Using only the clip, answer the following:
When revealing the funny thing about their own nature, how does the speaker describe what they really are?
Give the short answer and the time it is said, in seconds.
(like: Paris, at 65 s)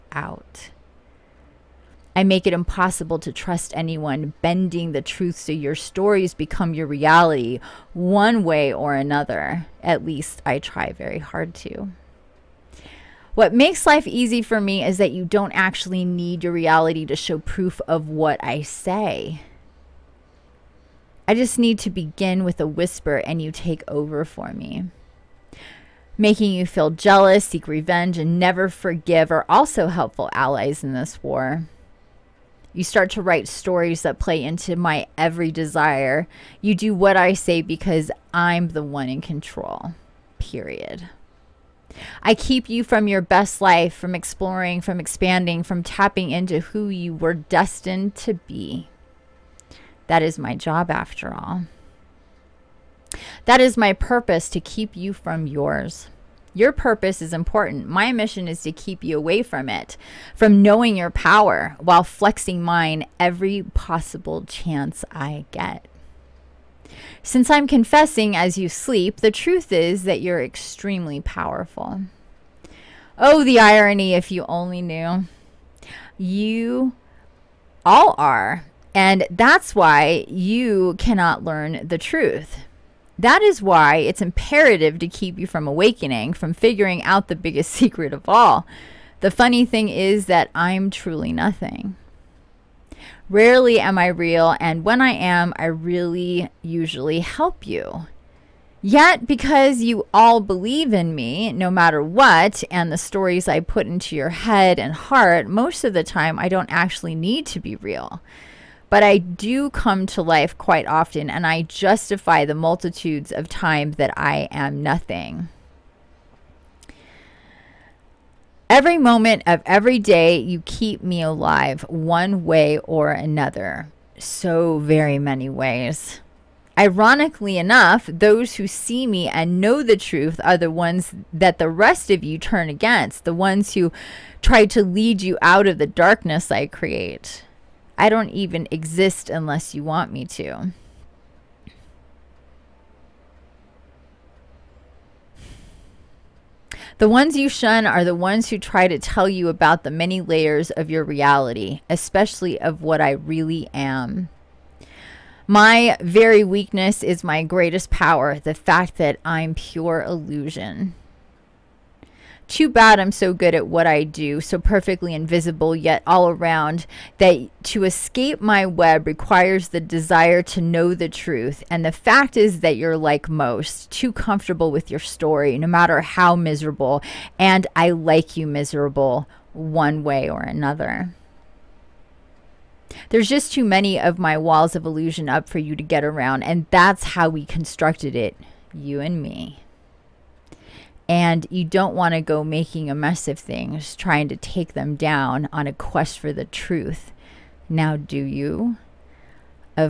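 truly nothing, at 90 s.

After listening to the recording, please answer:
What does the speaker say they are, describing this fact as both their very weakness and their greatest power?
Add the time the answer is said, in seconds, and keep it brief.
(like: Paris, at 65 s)
pure illusion, at 159 s.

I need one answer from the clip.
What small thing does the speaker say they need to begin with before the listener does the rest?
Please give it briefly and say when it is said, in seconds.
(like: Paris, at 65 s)
a whisper, at 22 s.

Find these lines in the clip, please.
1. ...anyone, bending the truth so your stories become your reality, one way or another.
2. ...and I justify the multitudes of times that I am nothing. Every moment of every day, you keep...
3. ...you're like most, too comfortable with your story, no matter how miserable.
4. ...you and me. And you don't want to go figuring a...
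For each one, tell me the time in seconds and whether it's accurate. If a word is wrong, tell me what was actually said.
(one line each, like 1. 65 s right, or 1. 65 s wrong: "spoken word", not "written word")
1. 3 s right
2. 111 s right
3. 172 s right
4. 188 s wrong: "making", not "figuring".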